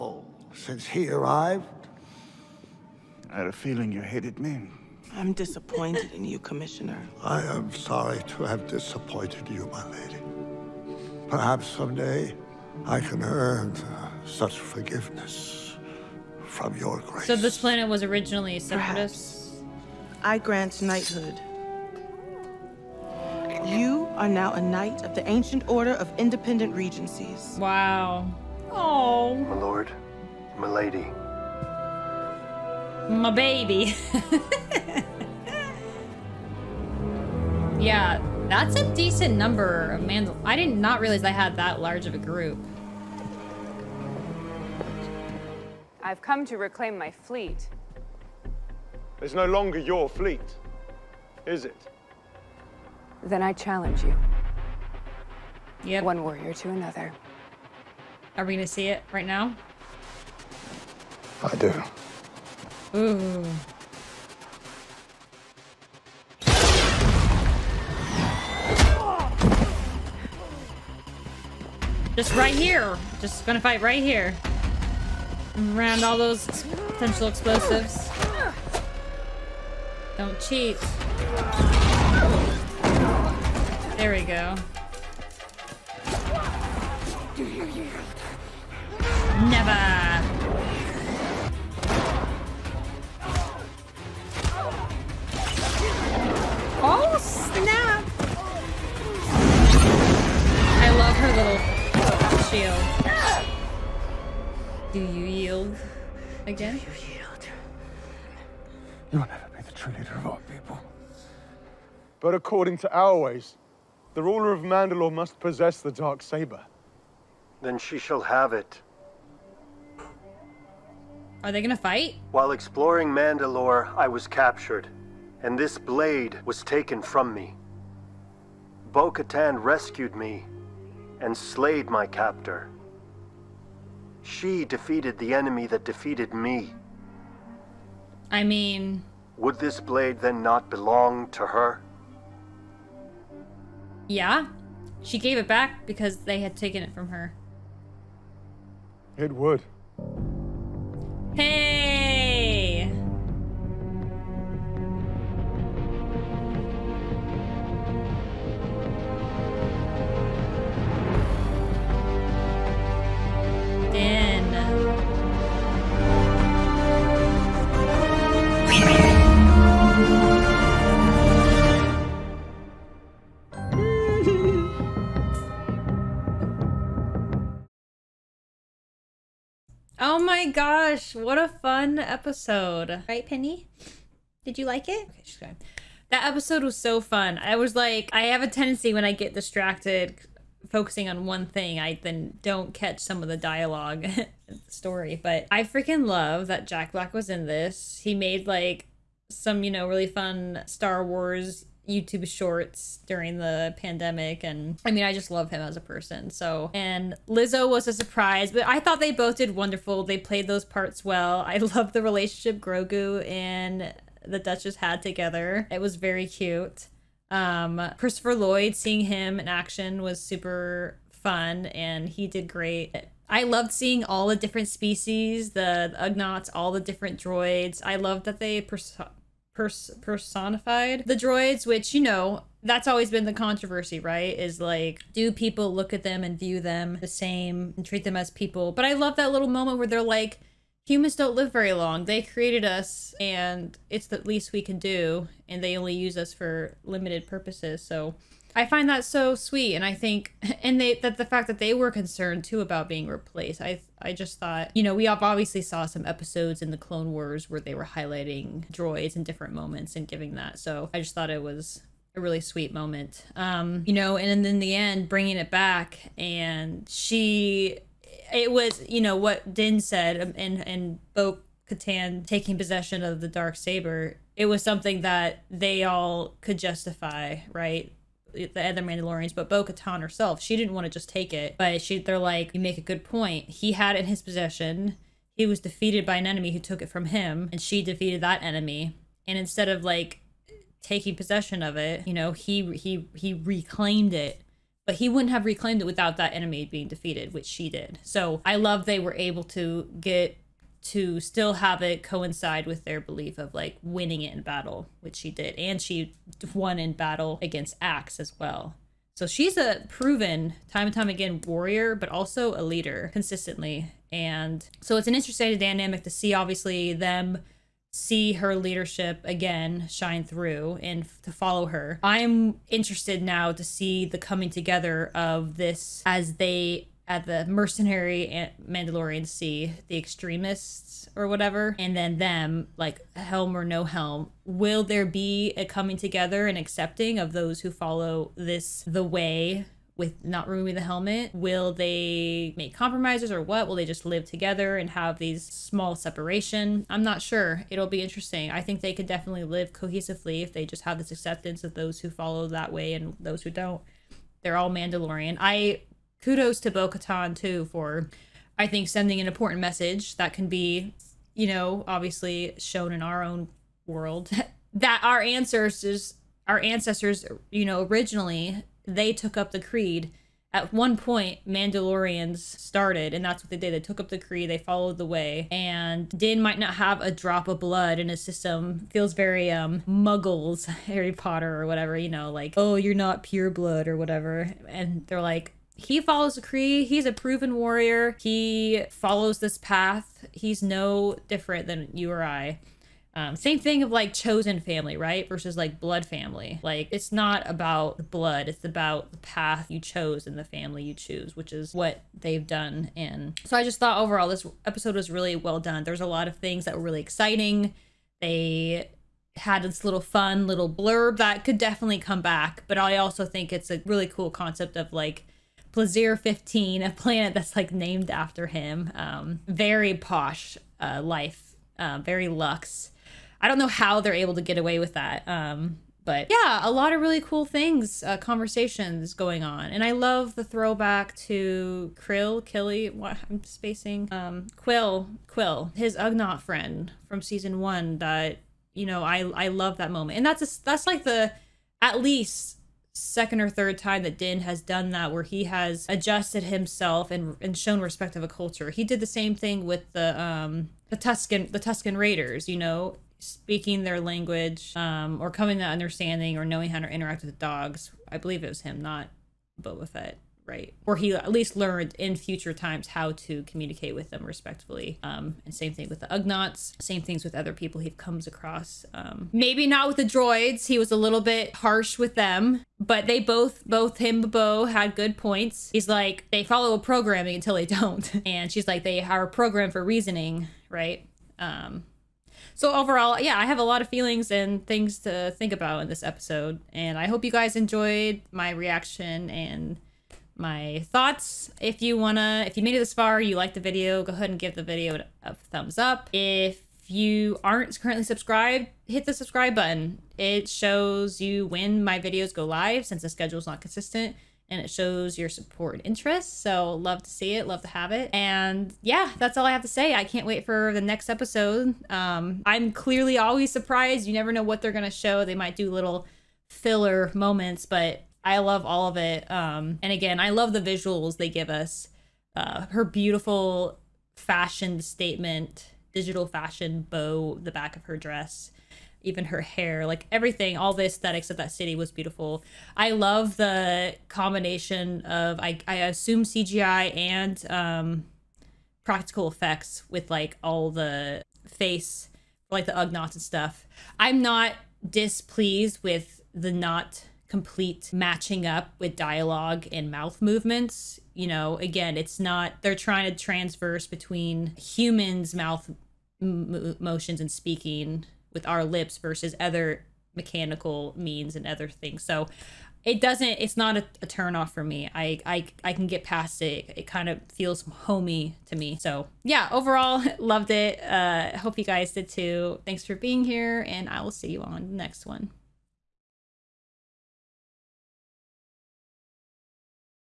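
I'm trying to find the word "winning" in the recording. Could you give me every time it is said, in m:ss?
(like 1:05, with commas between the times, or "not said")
5:03.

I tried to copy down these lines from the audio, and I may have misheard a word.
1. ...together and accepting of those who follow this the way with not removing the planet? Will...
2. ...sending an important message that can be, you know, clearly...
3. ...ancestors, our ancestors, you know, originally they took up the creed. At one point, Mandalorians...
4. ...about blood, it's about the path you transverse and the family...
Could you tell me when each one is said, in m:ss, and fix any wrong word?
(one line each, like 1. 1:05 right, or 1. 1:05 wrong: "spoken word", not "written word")
1. 5:35 wrong: "helmet", not "planet"
2. 5:58 wrong: "obviously", not "clearly"
3. 6:05 right
4. 6:37 wrong: "chose", not "transverse".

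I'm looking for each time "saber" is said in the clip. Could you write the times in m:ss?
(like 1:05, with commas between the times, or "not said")
1:56, 4:33.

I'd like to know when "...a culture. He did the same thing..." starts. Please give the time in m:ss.
7:28.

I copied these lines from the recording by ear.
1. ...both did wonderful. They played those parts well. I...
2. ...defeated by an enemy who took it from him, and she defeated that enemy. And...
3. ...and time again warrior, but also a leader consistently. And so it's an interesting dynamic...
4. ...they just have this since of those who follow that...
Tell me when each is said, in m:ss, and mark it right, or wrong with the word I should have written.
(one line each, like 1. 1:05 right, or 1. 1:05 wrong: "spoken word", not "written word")
1. 3:29 right
2. 4:45 right
3. 5:10 right
4. 5:50 wrong: "acceptance", not "since".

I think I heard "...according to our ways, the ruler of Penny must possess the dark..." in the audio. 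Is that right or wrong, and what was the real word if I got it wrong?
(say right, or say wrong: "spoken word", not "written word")
wrong: "Mandalore", not "Penny".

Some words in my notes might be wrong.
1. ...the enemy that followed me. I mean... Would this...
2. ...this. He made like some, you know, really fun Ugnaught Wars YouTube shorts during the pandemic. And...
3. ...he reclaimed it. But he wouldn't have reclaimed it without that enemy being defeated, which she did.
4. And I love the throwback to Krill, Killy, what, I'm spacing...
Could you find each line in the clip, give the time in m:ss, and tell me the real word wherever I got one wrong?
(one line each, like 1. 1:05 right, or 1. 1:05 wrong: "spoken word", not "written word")
1. 2:15 wrong: "defeated", not "followed"
2. 3:17 wrong: "Star", not "Ugnaught"
3. 4:53 right
4. 7:09 right.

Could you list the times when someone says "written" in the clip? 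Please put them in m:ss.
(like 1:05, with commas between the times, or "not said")
not said.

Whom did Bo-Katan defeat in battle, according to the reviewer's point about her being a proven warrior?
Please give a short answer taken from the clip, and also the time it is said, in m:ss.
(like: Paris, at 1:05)
Axe, at 5:07.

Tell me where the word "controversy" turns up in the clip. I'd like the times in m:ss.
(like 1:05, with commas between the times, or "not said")
3:53.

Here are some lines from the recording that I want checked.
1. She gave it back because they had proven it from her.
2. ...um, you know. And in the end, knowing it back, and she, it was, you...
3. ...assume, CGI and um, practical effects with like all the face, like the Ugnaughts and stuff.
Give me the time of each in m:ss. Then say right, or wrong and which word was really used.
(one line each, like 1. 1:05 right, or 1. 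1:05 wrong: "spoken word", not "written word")
1. 2:25 wrong: "taken", not "proven"
2. 4:23 wrong: "bringing", not "knowing"
3. 8:55 right.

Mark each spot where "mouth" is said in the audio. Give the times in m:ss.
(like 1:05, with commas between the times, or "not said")
9:09, 9:15.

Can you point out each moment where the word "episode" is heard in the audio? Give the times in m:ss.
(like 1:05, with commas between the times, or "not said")
3:01, 3:06, 4:16, 6:44, 8:06, 8:31.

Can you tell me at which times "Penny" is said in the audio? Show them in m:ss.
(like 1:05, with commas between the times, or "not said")
3:03.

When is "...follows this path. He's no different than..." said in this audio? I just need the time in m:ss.
6:28.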